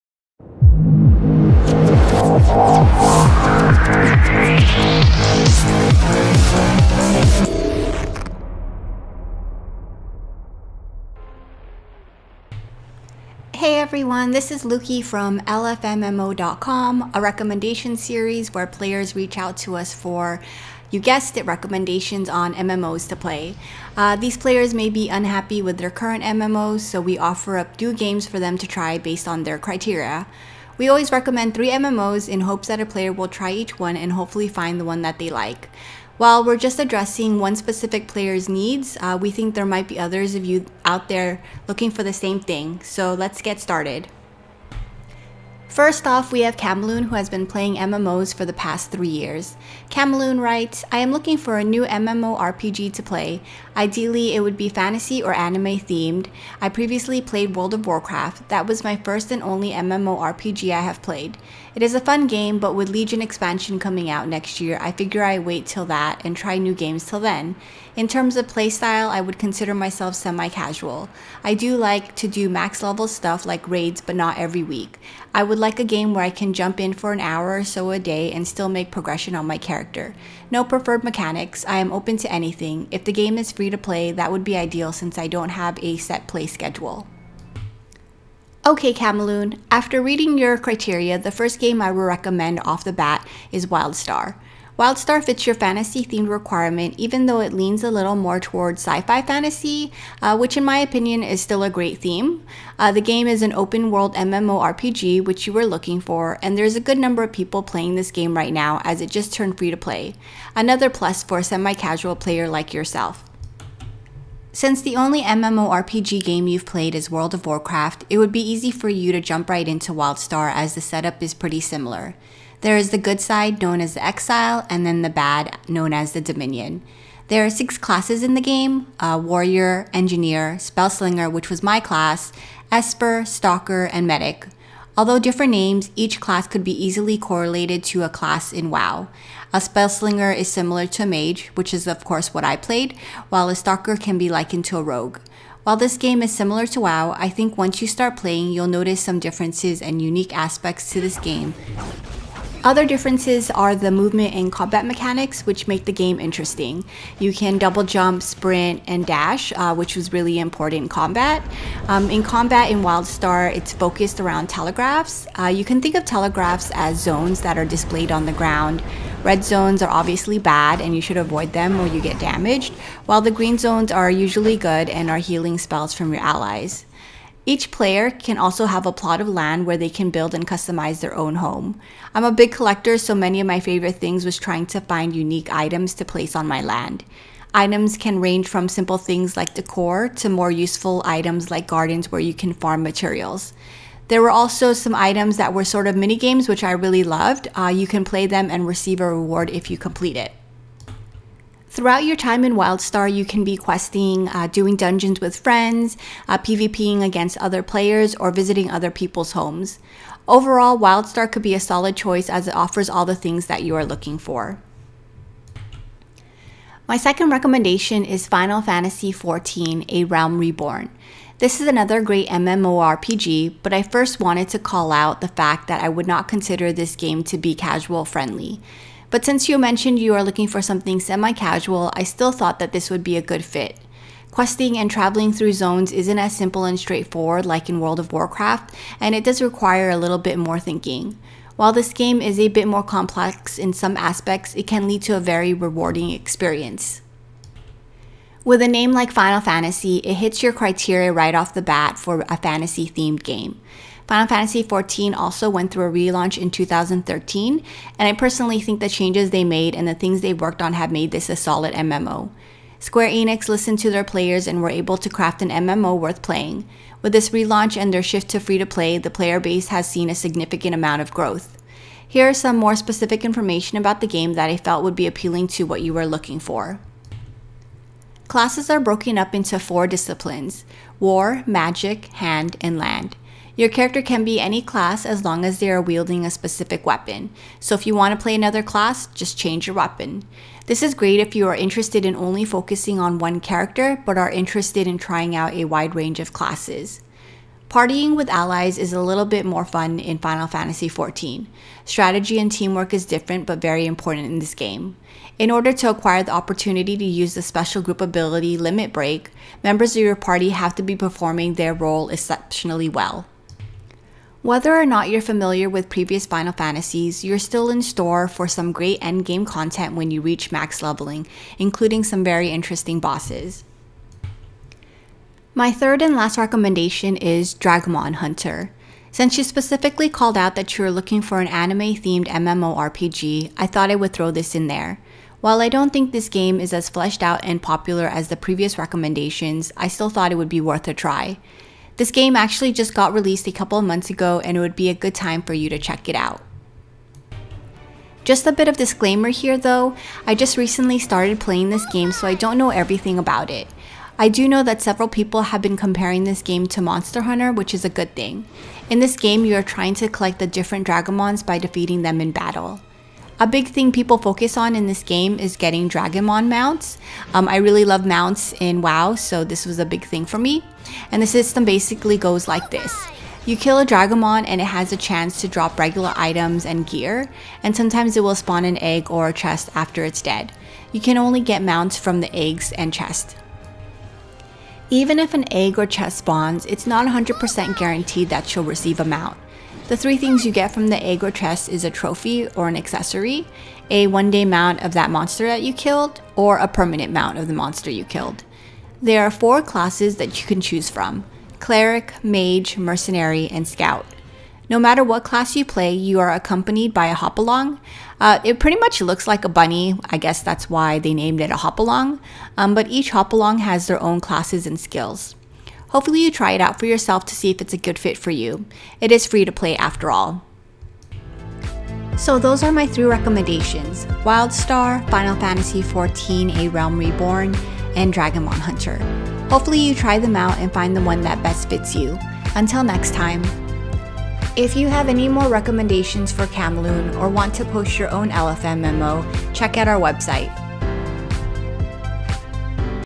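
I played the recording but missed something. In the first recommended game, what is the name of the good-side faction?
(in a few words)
Exile.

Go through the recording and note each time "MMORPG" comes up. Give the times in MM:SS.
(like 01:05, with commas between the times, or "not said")
00:51, 00:59, 01:44, 01:55, 03:42, 05:32.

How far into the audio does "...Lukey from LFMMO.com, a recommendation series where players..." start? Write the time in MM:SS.
00:14.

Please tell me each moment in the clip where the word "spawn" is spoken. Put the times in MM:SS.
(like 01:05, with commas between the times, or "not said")
06:18, 06:26.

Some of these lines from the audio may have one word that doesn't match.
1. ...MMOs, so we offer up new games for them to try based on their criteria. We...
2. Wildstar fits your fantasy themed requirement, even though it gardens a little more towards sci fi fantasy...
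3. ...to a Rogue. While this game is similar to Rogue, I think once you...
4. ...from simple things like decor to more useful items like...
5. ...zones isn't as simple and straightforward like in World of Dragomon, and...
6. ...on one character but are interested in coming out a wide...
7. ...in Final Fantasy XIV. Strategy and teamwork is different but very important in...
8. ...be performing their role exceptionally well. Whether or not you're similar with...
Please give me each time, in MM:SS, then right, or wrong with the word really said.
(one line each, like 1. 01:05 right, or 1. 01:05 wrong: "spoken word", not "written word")
1. 00:26 right
2. 01:34 wrong: "leans", not "gardens"
3. 02:24 wrong: "WoW", not "Rogue"
4. 03:08 right
5. 03:55 wrong: "Warcraft", not "Dragomon"
6. 04:52 wrong: "trying", not "coming"
7. 04:59 right
8. 05:10 wrong: "familiar", not "similar".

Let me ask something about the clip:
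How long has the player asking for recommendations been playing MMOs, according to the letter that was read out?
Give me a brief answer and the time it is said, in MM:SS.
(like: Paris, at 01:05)
3 years, at 00:48.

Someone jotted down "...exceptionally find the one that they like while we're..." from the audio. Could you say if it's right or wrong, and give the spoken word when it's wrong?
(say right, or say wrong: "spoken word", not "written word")
wrong: "hopefully", not "exceptionally".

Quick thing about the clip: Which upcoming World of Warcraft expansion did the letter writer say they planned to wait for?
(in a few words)
Legion.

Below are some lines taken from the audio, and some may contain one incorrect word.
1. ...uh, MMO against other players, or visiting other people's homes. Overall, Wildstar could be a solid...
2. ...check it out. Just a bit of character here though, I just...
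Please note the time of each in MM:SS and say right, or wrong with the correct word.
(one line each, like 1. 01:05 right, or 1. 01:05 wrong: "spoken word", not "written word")
1. 03:26 wrong: "PvPing", not "MMO"
2. 05:45 wrong: "disclaimer", not "character".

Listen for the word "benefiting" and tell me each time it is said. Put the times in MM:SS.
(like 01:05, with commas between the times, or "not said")
not said.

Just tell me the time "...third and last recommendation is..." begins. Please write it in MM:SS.
05:25.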